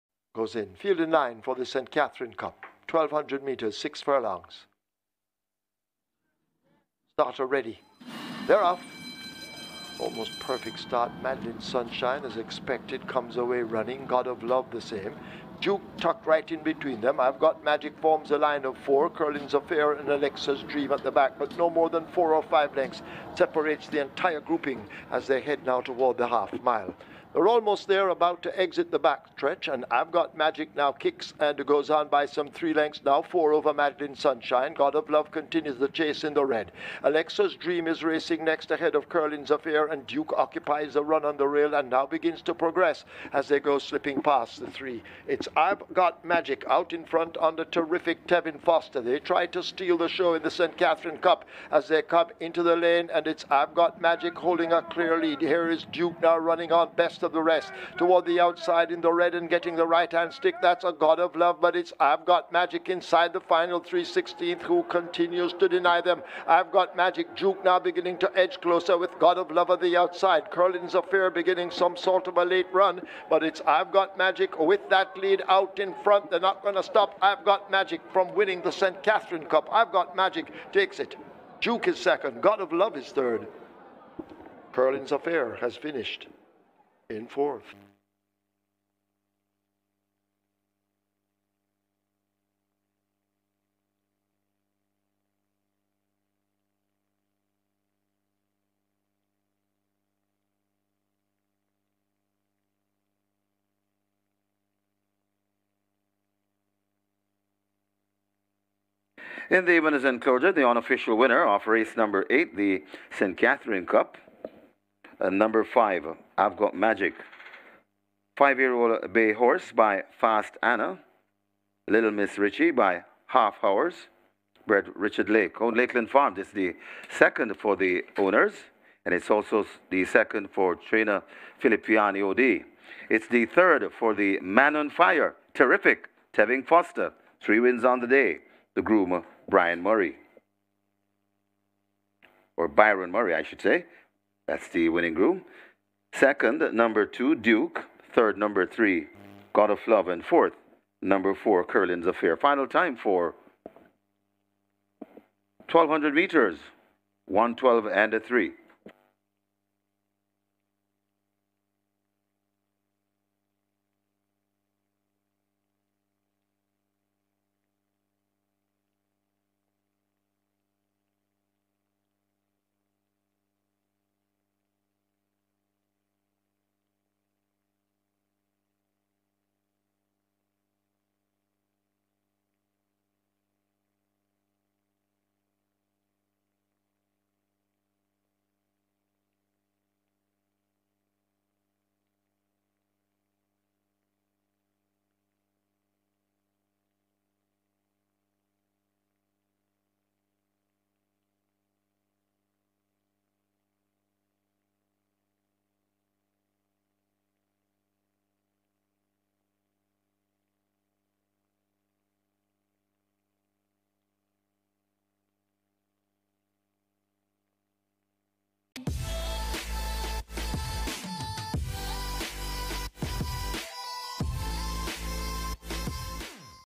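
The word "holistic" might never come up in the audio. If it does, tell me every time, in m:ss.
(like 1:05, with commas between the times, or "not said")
not said.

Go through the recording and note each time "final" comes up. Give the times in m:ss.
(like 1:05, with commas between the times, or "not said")
1:03, 2:32.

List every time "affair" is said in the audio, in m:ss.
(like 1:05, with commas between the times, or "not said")
0:19, 0:39, 1:10, 1:25, 2:32.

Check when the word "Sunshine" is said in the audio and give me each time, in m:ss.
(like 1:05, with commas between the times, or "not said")
0:11, 0:34.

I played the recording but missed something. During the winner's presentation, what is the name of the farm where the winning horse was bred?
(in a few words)
Lakeland Farm.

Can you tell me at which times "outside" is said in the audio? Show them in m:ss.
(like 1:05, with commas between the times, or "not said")
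0:58, 1:09.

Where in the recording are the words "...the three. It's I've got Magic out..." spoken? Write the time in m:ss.
0:44.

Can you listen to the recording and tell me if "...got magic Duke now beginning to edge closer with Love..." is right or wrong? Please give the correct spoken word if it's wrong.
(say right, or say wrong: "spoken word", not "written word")
wrong: "God", not "Love".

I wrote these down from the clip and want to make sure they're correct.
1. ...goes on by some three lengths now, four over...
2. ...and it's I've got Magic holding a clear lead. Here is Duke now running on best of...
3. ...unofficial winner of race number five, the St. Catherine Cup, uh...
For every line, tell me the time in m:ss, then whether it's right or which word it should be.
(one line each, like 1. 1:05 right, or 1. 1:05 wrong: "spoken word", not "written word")
1. 0:31 right
2. 0:53 right
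3. 1:50 wrong: "eight", not "five".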